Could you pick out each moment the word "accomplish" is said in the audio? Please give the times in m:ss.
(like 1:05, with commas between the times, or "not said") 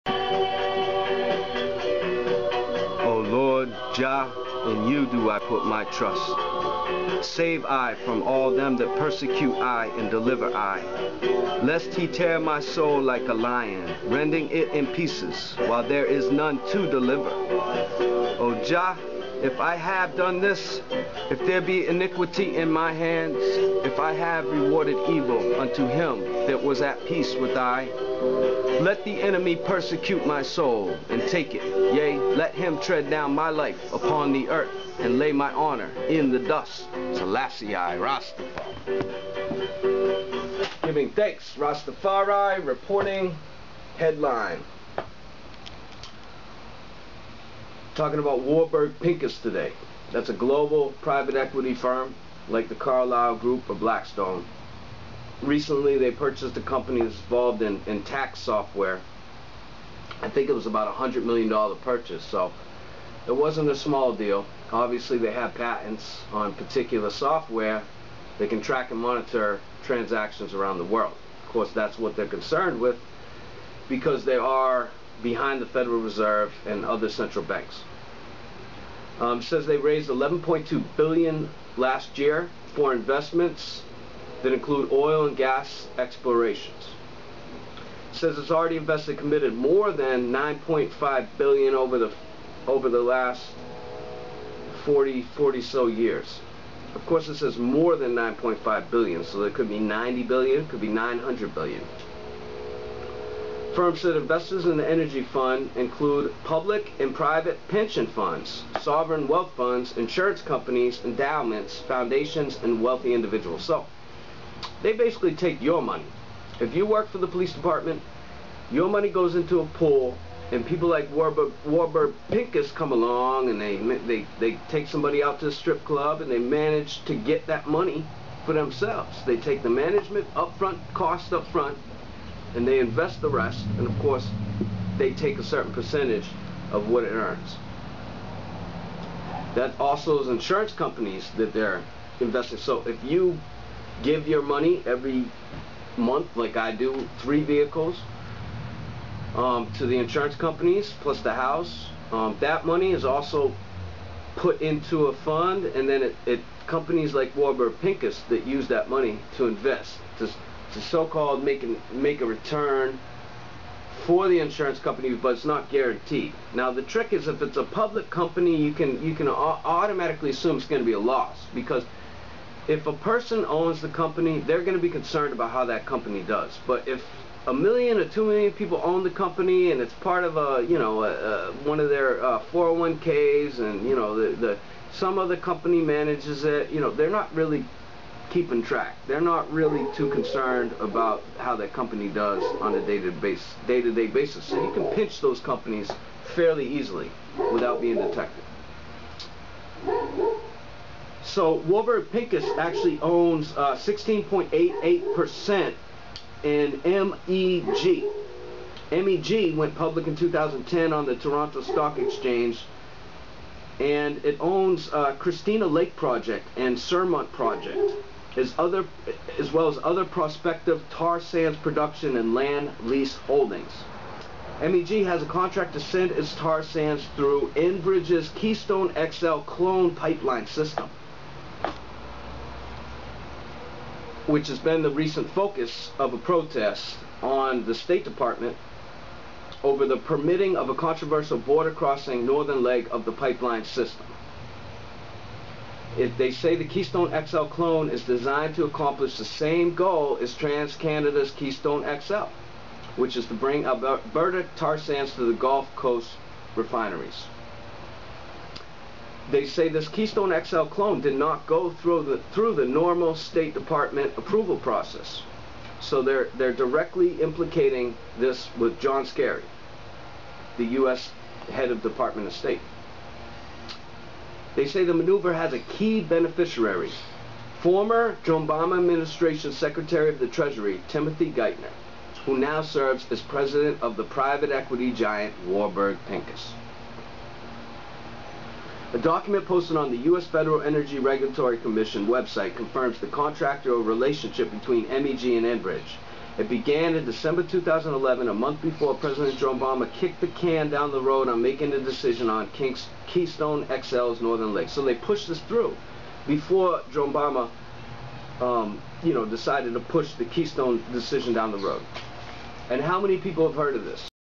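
4:08.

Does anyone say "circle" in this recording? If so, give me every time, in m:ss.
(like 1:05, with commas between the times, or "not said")
not said.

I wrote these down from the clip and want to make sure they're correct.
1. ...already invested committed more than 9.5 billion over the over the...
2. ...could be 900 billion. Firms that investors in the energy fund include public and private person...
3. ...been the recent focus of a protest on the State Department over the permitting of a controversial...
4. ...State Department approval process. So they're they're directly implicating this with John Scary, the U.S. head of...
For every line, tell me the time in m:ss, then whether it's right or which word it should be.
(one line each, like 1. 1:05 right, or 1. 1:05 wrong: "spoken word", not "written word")
1. 1:28 right
2. 1:40 wrong: "pension", not "person"
3. 3:54 right
4. 4:23 right.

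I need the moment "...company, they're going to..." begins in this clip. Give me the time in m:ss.
2:53.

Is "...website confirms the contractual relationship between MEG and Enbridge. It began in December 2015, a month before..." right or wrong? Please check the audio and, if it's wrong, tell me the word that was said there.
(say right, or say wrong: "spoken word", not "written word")
wrong: "2011", not "2015".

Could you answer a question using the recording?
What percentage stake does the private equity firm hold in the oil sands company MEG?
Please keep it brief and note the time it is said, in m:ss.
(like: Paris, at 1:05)
16.88%, at 3:23.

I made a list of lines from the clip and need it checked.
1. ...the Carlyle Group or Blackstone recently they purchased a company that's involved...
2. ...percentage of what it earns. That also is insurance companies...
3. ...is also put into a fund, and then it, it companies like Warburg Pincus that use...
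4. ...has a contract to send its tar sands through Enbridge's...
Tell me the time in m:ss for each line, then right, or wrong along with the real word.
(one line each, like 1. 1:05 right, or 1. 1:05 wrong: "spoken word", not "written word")
1. 0:52 right
2. 2:15 right
3. 2:32 right
4. 3:45 right.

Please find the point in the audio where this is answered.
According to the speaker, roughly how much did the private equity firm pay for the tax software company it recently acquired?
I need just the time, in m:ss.
1:00.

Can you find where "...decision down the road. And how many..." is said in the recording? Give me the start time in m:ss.
5:10.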